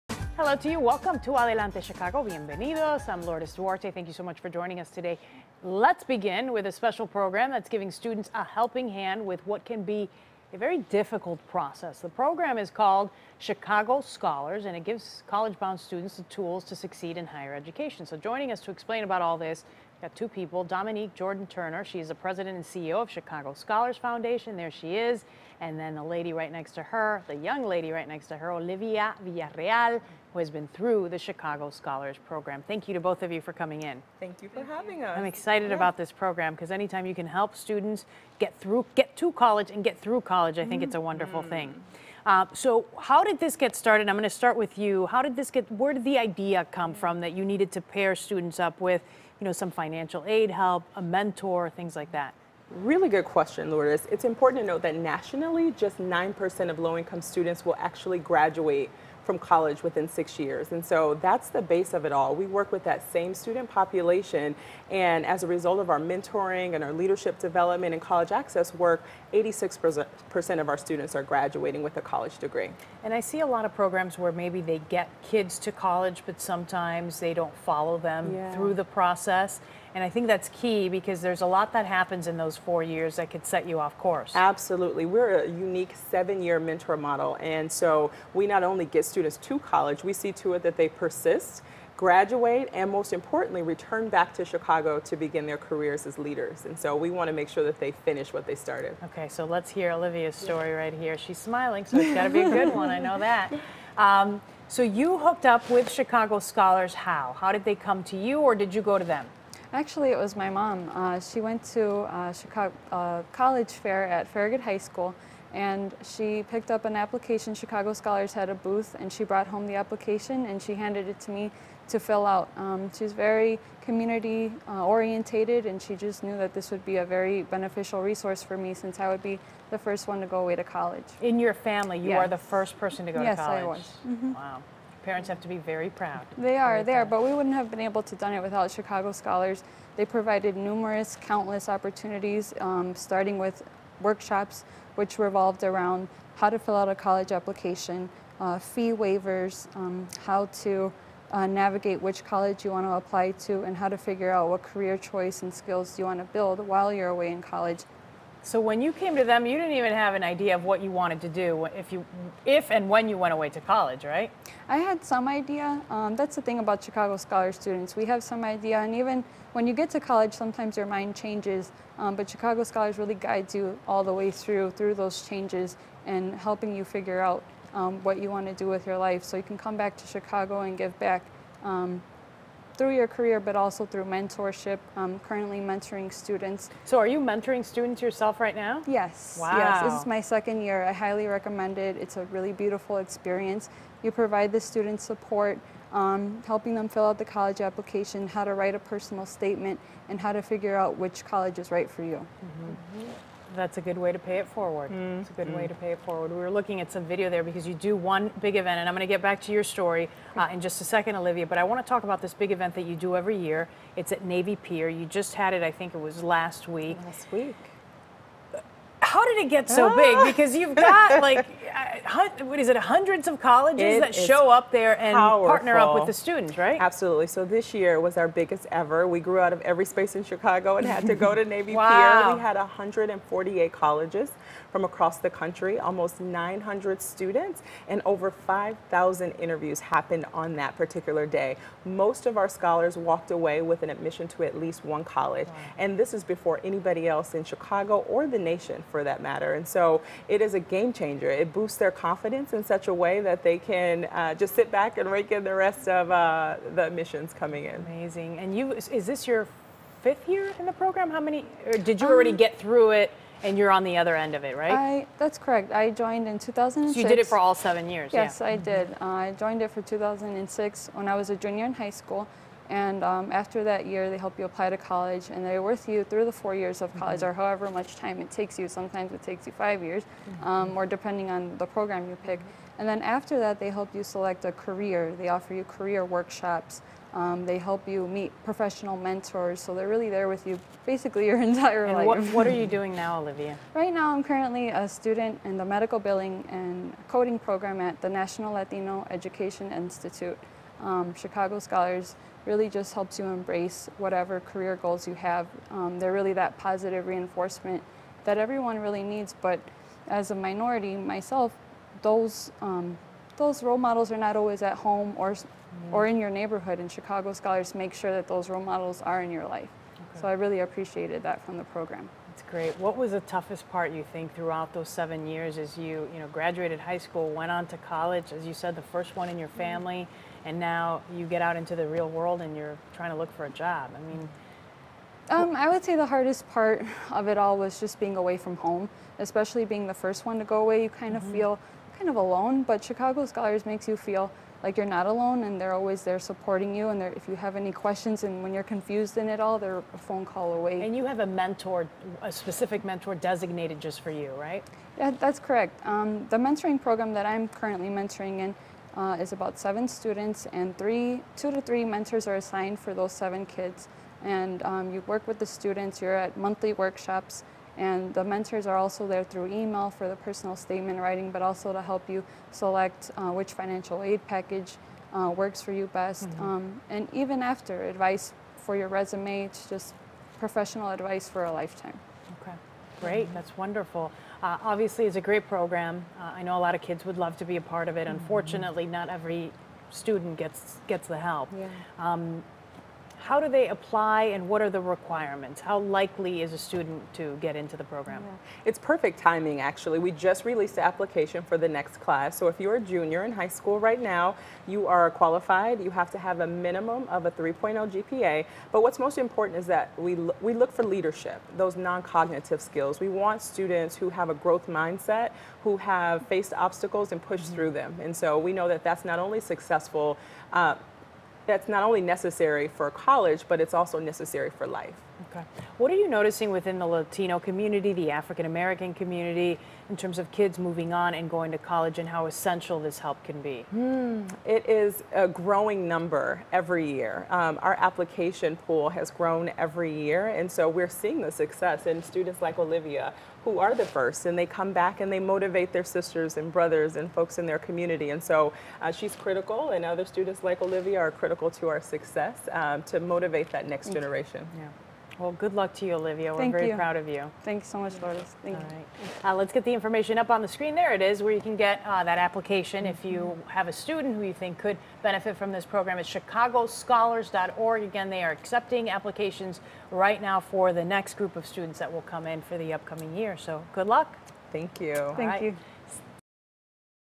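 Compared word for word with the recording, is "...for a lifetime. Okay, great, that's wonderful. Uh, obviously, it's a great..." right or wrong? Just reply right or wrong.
right.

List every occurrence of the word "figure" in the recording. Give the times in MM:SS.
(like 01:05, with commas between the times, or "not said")
02:33, 02:56, 03:20.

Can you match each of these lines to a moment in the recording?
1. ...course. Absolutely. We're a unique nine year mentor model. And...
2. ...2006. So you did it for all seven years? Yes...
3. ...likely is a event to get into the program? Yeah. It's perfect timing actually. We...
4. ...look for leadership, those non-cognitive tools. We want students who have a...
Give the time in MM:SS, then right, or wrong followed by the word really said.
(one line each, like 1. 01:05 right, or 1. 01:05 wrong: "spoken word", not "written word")
1. 01:23 wrong: "seven", not "nine"
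2. 04:26 right
3. 06:35 wrong: "student", not "event"
4. 06:50 wrong: "skills", not "tools".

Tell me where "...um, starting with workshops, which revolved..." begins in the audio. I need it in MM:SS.
02:22.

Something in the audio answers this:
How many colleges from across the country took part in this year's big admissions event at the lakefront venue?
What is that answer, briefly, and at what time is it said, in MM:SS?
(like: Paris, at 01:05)
148, at 03:52.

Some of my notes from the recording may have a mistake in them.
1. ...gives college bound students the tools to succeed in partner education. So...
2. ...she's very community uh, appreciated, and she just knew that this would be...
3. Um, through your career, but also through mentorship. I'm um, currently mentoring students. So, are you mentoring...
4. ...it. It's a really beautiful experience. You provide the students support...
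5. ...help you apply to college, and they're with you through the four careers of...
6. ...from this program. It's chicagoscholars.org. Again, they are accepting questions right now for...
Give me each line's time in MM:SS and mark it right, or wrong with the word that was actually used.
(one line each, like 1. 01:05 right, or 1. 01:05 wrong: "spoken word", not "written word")
1. 00:14 wrong: "higher", not "partner"
2. 02:02 wrong: "orientated", not "appreciated"
3. 03:01 right
4. 03:11 right
5. 04:34 wrong: "years", not "careers"
6. 07:45 wrong: "applications", not "questions".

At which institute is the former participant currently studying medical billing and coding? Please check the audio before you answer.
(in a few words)
National Latino Education Institute.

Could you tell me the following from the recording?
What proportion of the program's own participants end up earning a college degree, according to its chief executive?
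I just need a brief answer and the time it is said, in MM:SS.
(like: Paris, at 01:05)
86%, at 01:09.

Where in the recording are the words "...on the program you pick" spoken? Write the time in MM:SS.
04:41.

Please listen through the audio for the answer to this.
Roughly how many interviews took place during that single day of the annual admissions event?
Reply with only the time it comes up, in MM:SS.
03:58.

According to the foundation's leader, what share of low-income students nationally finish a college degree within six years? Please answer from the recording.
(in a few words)
9%.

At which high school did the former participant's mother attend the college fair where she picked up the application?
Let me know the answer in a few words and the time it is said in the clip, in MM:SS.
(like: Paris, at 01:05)
Farragut High School, at 01:54.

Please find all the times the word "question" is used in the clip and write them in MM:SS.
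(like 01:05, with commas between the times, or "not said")
00:53, 05:47.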